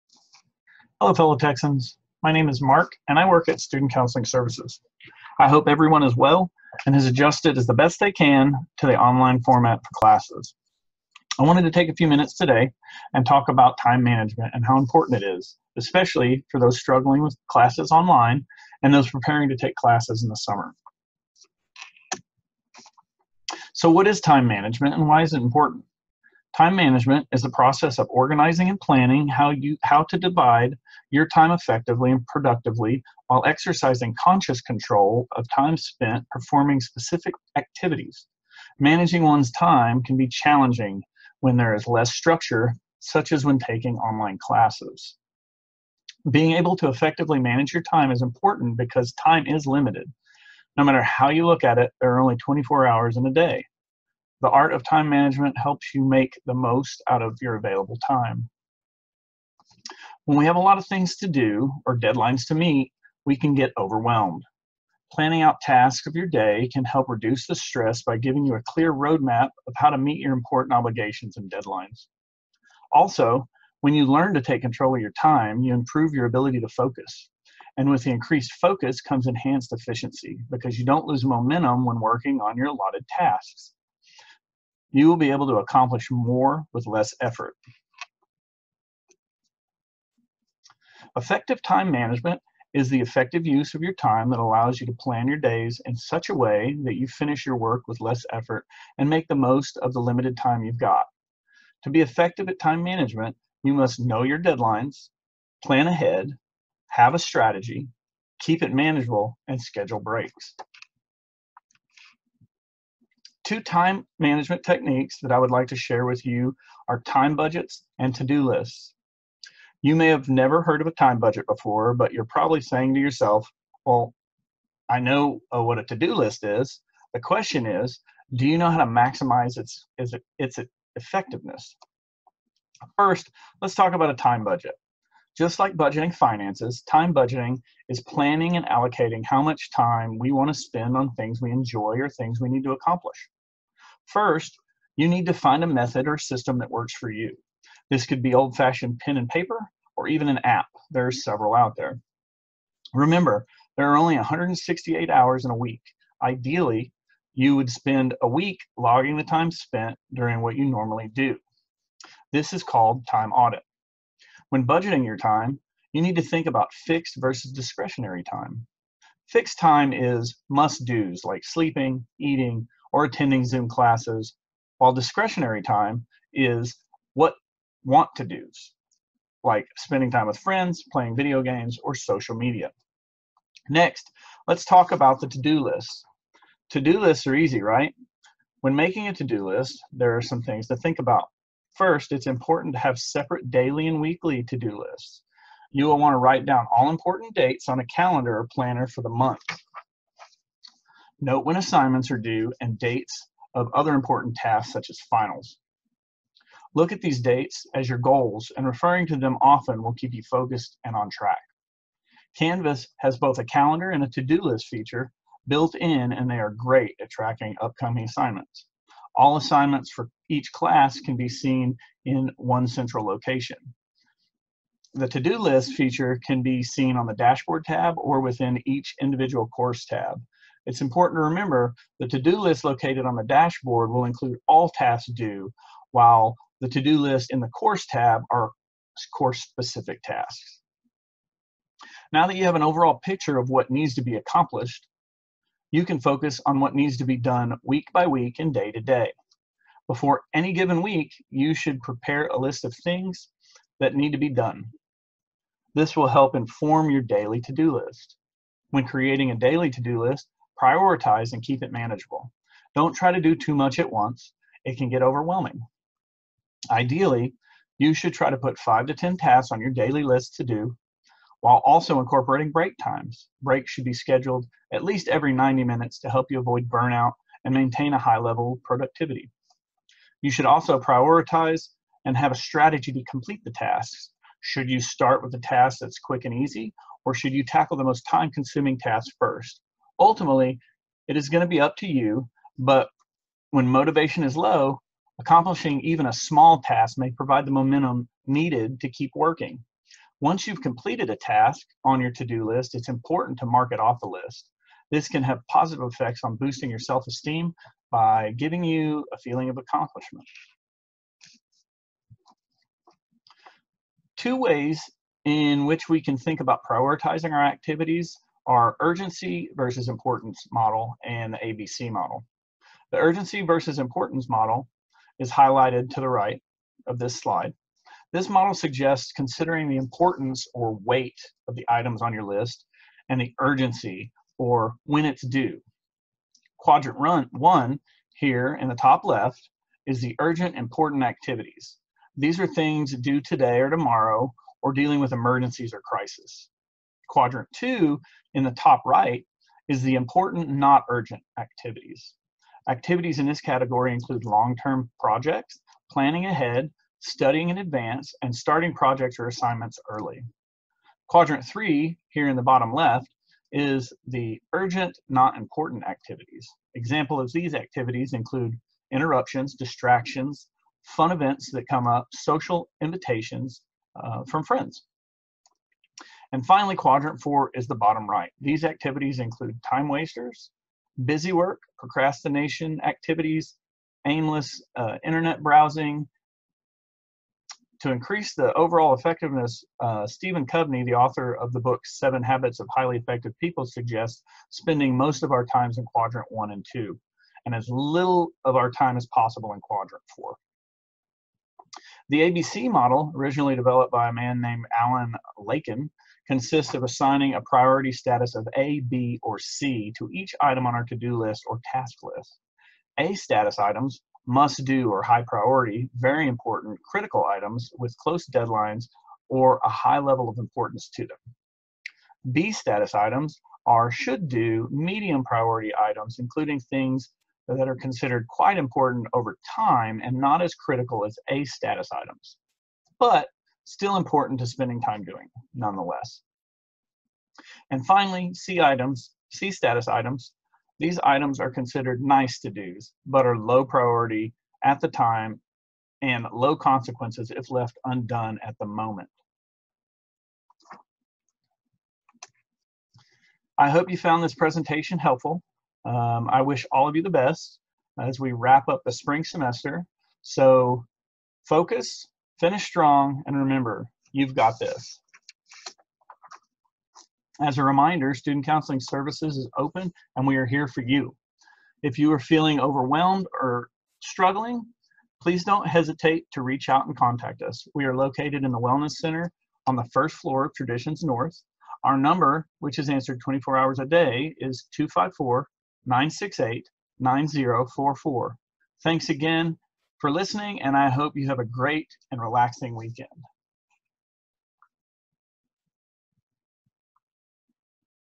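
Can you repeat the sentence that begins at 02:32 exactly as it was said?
Remember, there are only 168 hours in a week.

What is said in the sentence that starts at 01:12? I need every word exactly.
Also, when you learn to take control of your time, you improve your ability to focus.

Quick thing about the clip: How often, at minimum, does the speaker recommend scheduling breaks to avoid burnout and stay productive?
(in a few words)
every 90 minutes.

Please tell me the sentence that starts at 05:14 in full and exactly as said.
Two ways in which we can think about prioritizing our activities are urgency versus importance model and the ABC model.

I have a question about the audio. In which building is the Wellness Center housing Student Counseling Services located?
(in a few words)
Traditions North.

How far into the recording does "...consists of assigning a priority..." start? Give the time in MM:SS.
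06:46.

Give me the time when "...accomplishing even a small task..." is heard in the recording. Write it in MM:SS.
04:55.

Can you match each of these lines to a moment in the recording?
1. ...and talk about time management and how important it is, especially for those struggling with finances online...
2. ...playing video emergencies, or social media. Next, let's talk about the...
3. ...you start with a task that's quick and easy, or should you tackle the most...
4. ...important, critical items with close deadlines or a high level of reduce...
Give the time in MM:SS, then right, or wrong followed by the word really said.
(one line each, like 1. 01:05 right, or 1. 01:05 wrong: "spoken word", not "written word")
1. 00:13 wrong: "classes", not "finances"
2. 03:00 wrong: "games", not "emergencies"
3. 04:44 right
4. 06:56 wrong: "importance", not "reduce".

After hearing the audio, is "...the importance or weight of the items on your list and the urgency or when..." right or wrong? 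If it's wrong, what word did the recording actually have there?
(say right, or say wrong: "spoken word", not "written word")
right.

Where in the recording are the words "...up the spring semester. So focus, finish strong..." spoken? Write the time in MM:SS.
07:38.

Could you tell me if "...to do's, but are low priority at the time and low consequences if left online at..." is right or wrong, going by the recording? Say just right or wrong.
wrong.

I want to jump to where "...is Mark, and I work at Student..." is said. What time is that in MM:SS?
00:02.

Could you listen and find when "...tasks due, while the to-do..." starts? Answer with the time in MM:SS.
03:54.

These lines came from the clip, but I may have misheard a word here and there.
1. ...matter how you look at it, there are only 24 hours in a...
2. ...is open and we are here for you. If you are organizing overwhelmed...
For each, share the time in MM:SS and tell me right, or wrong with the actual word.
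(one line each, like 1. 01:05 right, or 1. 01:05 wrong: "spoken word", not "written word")
1. 00:50 right
2. 07:49 wrong: "feeling", not "organizing".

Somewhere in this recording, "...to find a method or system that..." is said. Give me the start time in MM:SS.
02:25.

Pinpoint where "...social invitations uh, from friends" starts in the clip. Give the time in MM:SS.
06:12.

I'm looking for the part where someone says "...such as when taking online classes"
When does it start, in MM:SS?
00:42.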